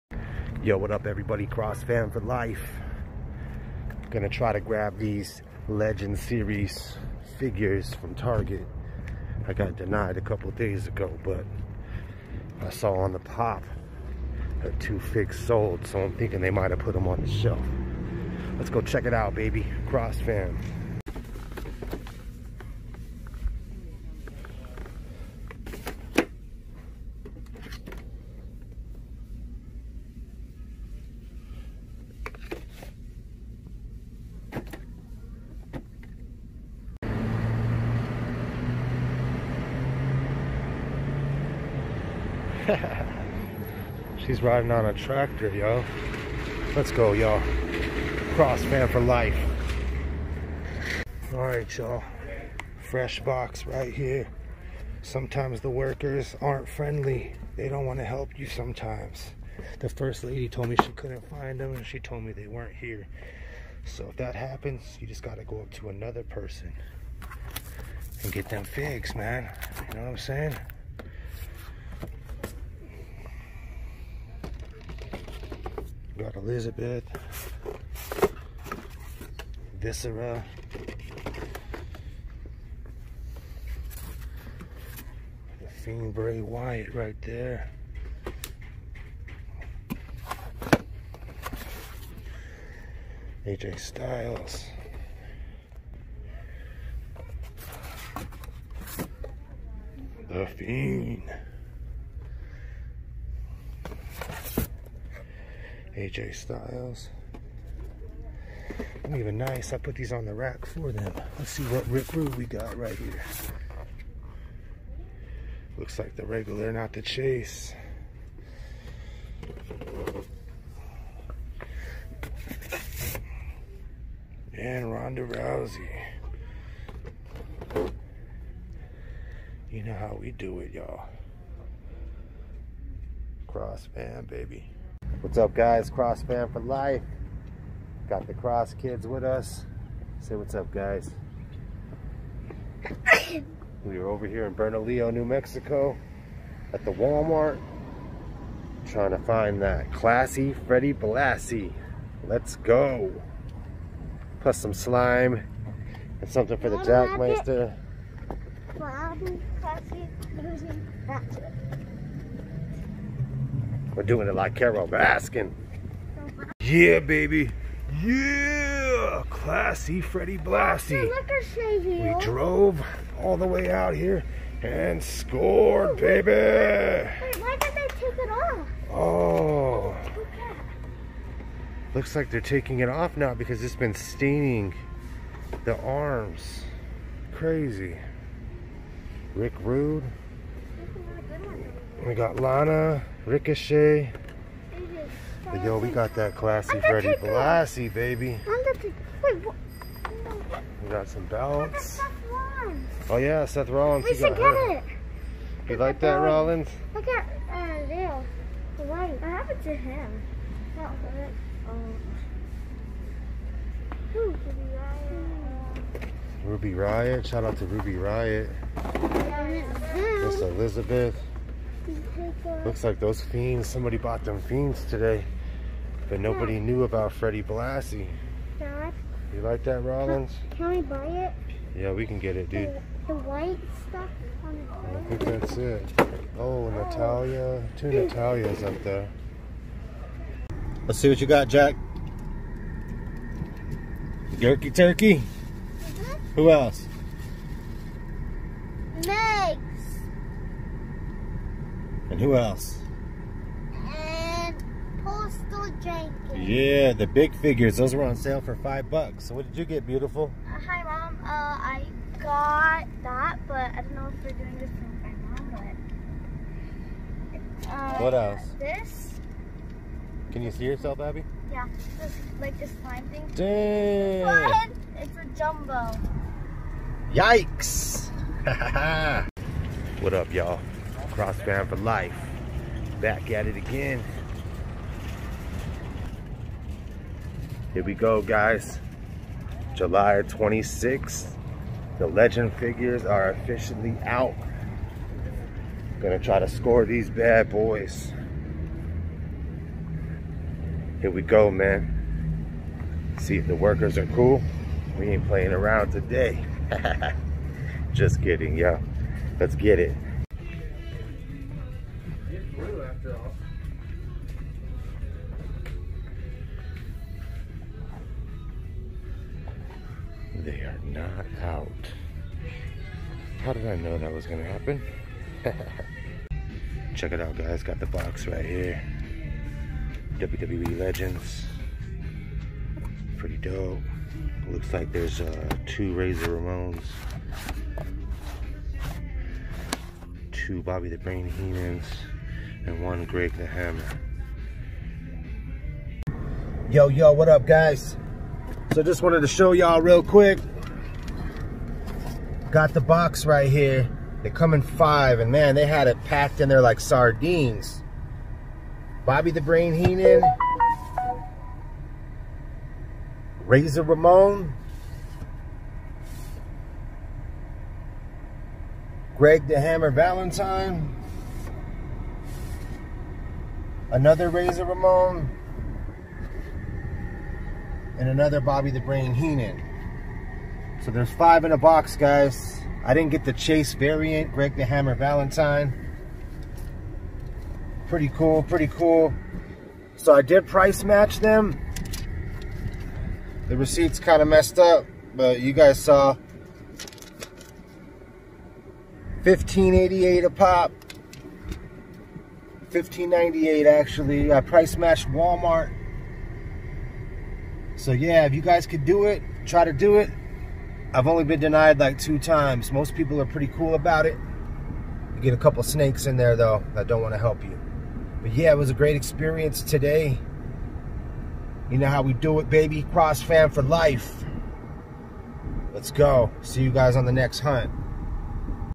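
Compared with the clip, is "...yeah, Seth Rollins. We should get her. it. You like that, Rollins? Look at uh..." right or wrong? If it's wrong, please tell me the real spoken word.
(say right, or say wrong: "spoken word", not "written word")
right.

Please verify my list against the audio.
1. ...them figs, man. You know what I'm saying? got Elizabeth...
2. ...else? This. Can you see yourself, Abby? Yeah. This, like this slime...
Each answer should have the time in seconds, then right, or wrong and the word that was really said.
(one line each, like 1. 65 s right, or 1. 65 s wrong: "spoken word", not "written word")
1. 68 s right
2. 268 s right.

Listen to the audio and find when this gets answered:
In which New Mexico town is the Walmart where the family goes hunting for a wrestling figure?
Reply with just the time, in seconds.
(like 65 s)
144 s.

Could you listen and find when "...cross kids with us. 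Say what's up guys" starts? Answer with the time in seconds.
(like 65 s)
138 s.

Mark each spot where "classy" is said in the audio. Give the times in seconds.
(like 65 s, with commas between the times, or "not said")
149 s, 169 s, 196 s.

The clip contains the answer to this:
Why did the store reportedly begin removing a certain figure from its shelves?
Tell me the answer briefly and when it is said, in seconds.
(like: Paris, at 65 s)
Staining the arms, at 183 s.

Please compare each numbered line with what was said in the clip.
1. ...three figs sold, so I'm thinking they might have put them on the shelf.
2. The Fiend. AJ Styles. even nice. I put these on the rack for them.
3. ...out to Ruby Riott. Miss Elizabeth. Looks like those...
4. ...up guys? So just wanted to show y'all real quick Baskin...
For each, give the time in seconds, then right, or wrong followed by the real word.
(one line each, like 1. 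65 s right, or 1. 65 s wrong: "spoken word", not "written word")
1. 14 s wrong: "two", not "three"
2. 100 s right
3. 217 s right
4. 347 s wrong: "Got", not "Baskin".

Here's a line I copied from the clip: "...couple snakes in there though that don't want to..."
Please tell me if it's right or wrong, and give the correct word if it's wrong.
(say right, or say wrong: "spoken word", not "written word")
right.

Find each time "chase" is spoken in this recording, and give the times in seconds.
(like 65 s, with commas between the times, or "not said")
117 s, 383 s.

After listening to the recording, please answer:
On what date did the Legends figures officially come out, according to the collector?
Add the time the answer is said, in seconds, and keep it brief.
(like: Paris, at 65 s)
July 26th, at 289 s.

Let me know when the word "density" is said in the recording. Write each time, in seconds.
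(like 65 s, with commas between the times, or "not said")
not said.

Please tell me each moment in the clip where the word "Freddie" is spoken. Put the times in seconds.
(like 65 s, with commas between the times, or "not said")
150 s, 169 s, 196 s, 227 s.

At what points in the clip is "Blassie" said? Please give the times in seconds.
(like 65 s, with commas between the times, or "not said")
150 s, 170 s, 197 s, 227 s.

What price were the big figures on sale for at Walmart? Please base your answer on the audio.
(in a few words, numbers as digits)
5 bucks.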